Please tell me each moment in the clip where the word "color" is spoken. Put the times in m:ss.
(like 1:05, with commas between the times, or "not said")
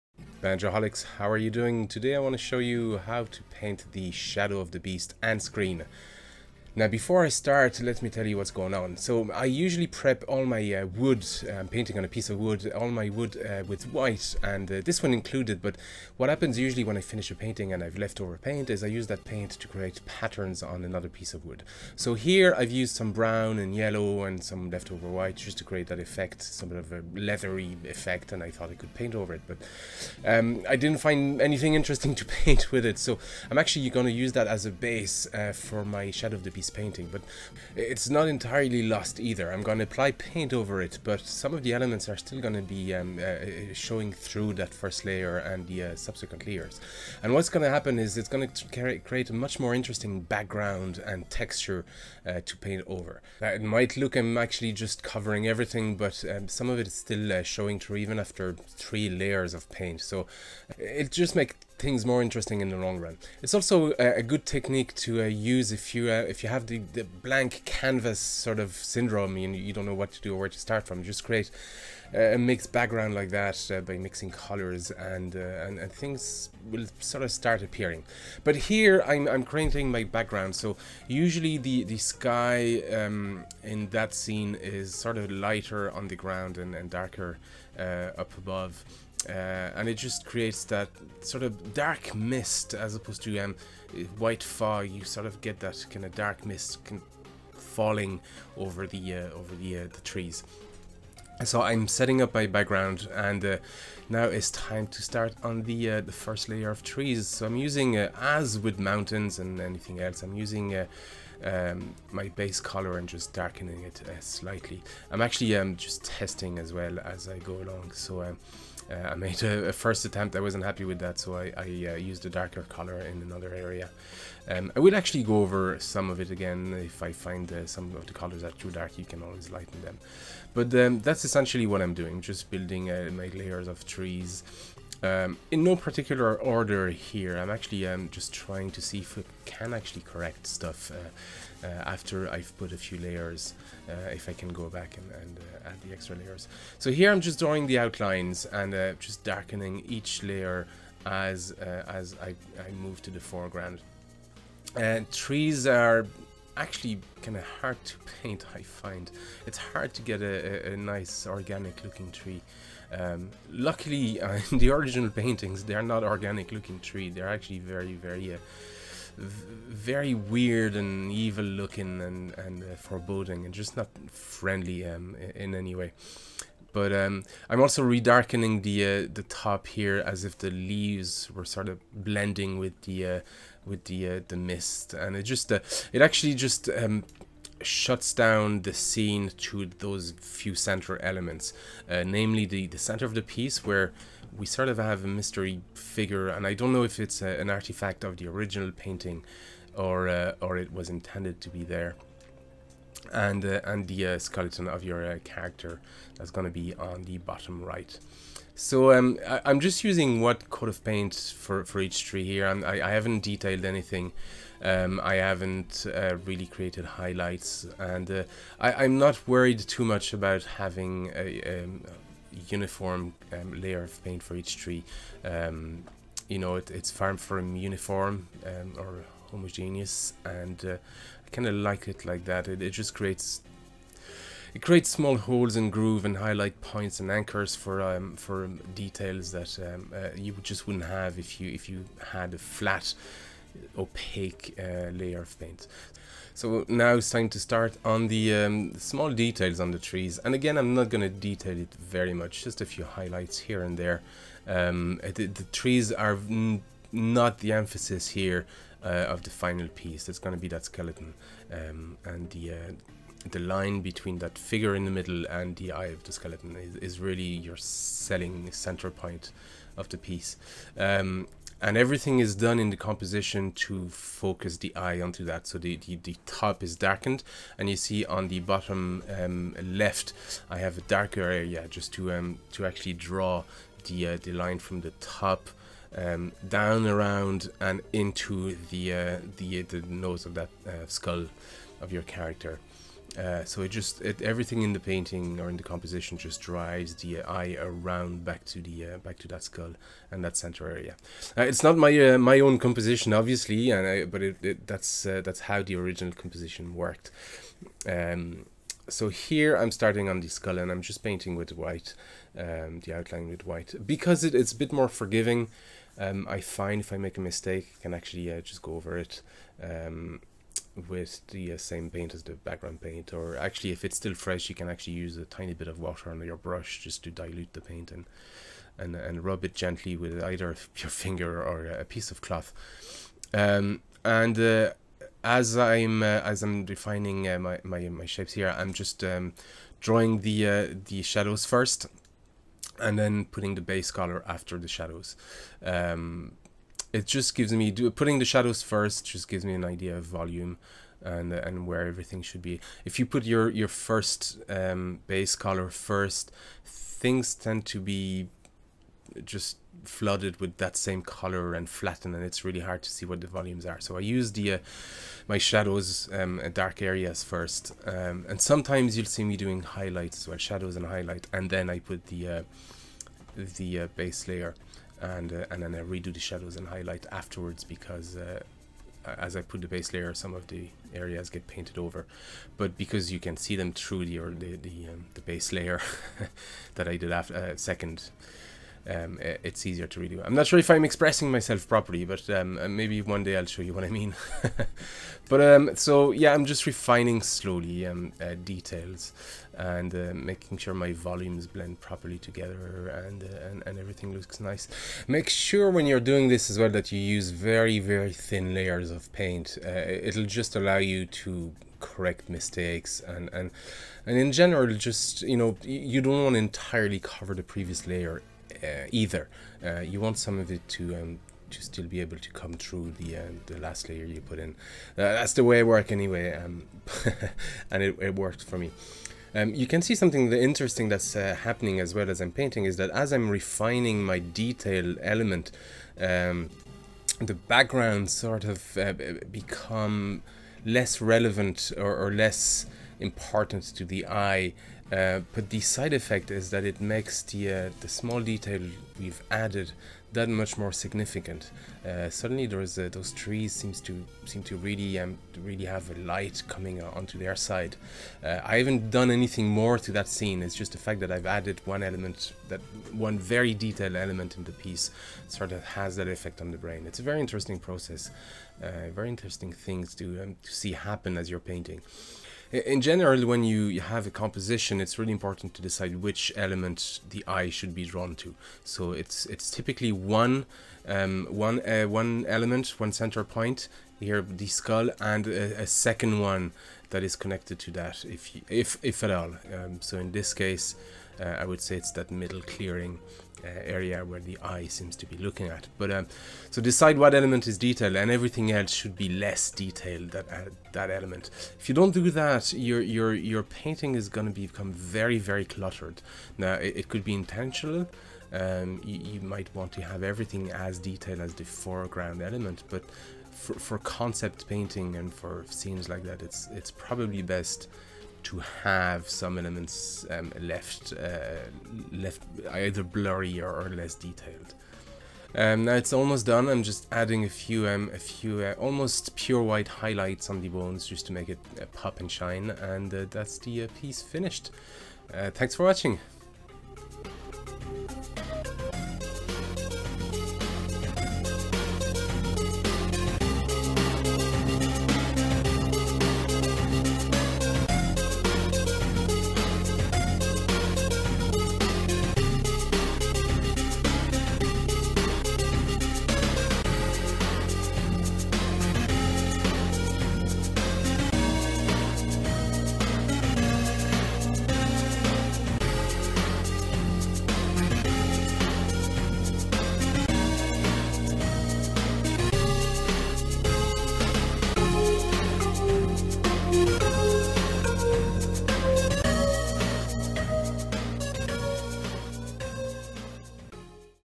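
1:14, 1:52, 2:02, 2:08, 5:43, 5:55, 6:01.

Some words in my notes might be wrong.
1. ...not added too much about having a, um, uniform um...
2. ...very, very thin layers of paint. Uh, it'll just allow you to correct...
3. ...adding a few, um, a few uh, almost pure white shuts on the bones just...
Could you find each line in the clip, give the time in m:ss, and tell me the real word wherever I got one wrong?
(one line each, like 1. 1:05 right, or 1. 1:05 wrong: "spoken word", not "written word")
1. 3:38 wrong: "worried", not "added"
2. 6:47 right
3. 8:46 wrong: "highlights", not "shuts".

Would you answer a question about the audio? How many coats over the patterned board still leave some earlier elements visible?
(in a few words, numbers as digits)
3.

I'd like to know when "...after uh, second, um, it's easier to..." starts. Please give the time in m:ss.
6:27.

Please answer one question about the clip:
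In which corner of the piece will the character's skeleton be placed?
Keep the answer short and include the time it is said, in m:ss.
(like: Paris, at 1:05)
Bottom right, at 3:27.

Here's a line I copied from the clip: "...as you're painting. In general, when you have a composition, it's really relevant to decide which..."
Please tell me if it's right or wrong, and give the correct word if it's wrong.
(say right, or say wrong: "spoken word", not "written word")
wrong: "important", not "relevant".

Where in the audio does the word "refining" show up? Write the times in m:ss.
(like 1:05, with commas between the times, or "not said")
6:36, 7:13.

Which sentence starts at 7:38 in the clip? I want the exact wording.
Uh, I haven't done anything more to that scene.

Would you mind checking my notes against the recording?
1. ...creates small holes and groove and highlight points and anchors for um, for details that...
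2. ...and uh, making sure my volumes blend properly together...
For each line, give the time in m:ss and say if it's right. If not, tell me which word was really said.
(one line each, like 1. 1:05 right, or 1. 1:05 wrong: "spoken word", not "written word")
1. 3:54 right
2. 6:39 right.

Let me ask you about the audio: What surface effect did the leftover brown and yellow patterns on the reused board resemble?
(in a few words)
Leathery effect.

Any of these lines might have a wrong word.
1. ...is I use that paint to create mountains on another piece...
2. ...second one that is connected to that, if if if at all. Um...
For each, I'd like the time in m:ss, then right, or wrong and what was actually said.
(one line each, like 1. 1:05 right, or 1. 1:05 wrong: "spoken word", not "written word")
1. 0:18 wrong: "patterns", not "mountains"
2. 8:05 right.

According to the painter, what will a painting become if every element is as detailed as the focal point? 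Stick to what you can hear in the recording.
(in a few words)
Very cluttered.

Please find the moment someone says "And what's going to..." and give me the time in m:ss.
0:47.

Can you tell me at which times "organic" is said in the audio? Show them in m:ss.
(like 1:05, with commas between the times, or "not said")
2:41, 2:46.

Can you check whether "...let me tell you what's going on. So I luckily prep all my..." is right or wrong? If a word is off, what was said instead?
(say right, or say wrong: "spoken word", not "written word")
wrong: "usually", not "luckily".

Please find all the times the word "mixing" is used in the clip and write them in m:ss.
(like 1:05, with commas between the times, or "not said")
1:13.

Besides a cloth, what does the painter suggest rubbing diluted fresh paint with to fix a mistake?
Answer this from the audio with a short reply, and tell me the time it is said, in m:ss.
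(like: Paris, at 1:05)
Finger, at 5:30.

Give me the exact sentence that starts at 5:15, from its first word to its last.
Um, I find if I make a mistake, I can actually just go over it.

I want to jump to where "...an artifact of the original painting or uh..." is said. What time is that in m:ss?
3:17.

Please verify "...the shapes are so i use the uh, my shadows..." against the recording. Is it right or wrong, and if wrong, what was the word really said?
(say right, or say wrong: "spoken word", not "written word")
wrong: "volumes", not "shapes".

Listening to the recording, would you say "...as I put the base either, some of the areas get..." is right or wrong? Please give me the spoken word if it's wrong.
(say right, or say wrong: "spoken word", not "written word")
wrong: "layer", not "either".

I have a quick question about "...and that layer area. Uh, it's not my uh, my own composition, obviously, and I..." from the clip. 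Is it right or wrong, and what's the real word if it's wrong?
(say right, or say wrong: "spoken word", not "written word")
wrong: "center", not "layer".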